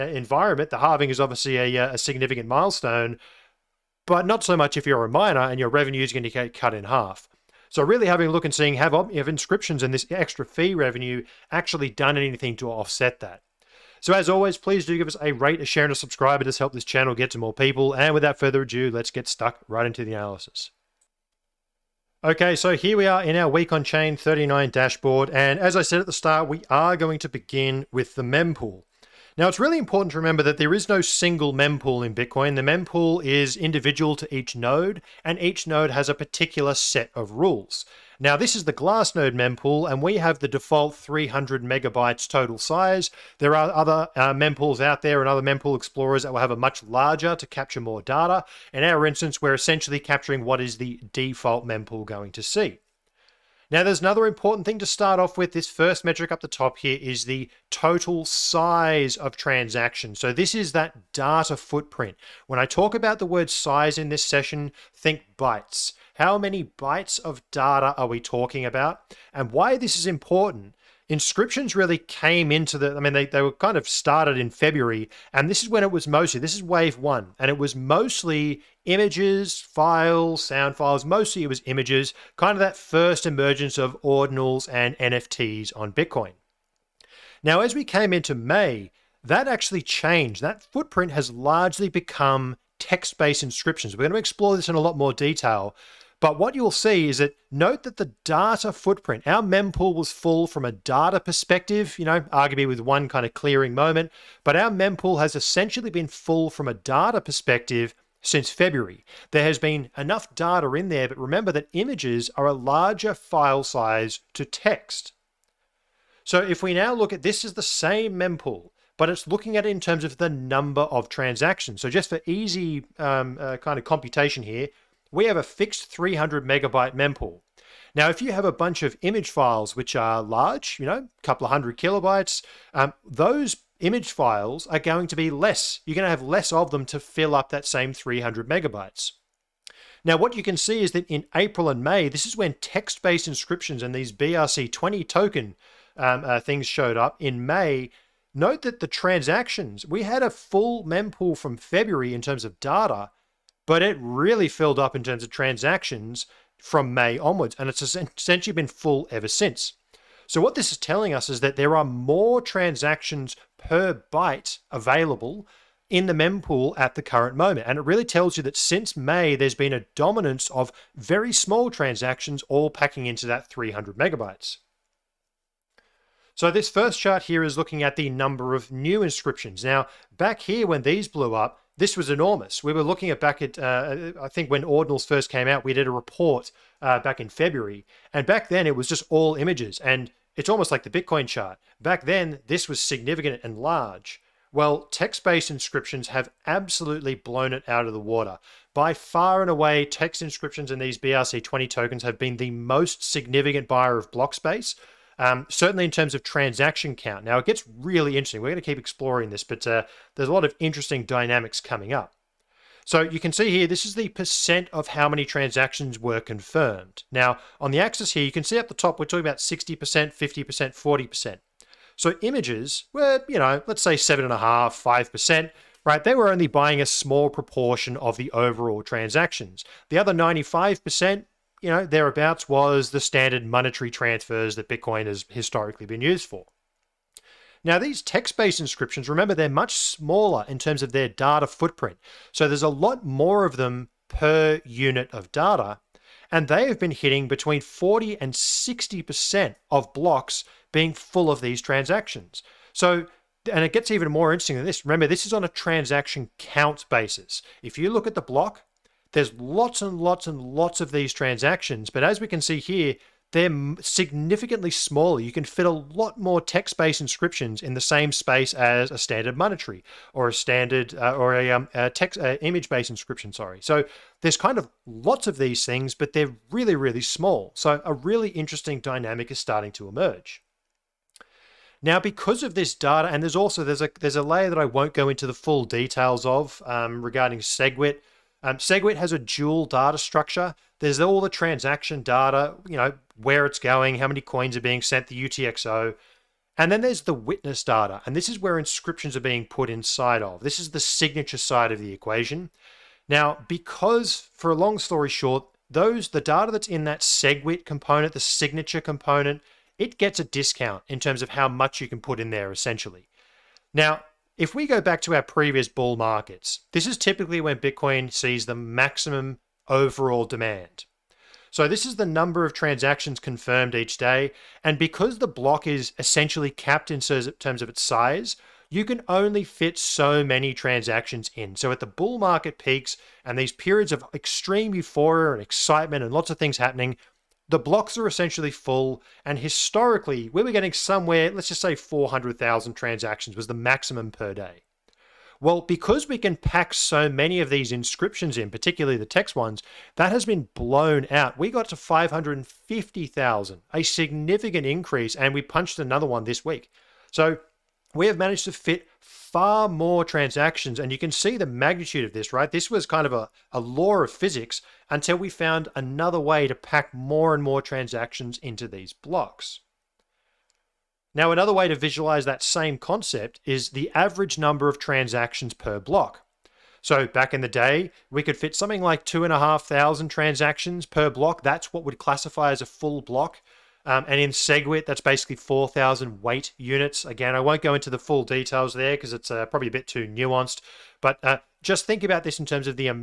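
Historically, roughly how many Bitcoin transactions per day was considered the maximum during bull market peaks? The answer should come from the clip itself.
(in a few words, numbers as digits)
400,000.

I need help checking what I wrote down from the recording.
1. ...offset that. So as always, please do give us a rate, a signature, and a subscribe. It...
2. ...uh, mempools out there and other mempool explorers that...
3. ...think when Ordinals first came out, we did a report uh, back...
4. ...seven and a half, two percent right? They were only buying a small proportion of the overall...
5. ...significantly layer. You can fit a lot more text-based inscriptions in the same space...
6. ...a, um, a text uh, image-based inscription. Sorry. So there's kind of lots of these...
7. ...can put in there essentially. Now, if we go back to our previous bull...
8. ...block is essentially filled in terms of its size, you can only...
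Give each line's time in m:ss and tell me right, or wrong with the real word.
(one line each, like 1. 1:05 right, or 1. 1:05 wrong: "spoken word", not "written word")
1. 0:12 wrong: "share", not "signature"
2. 0:44 right
3. 3:04 right
4. 3:43 wrong: "five", not "two"
5. 4:23 wrong: "smaller", not "layer"
6. 4:31 right
7. 5:11 right
8. 5:25 wrong: "capped", not "filled".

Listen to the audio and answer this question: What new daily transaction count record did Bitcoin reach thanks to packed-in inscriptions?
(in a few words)
550,000.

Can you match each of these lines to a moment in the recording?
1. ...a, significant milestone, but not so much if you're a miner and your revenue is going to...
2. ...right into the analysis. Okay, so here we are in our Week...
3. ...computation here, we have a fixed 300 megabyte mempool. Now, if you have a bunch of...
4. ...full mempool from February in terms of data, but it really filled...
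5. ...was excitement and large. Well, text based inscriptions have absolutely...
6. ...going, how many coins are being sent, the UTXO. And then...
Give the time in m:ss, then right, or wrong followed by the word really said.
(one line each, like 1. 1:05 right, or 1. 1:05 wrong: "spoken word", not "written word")
1. 0:01 right
2. 0:19 right
3. 2:03 right
4. 2:30 right
5. 3:12 wrong: "significant", not "excitement"
6. 4:53 right.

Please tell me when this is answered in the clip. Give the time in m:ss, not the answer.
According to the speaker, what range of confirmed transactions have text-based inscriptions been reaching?
4:07.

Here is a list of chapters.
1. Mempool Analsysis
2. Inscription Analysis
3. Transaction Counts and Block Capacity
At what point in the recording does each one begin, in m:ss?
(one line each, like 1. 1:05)
1. 0:20
2. 2:54
3. 4:40.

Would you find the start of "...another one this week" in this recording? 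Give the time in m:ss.
5:55.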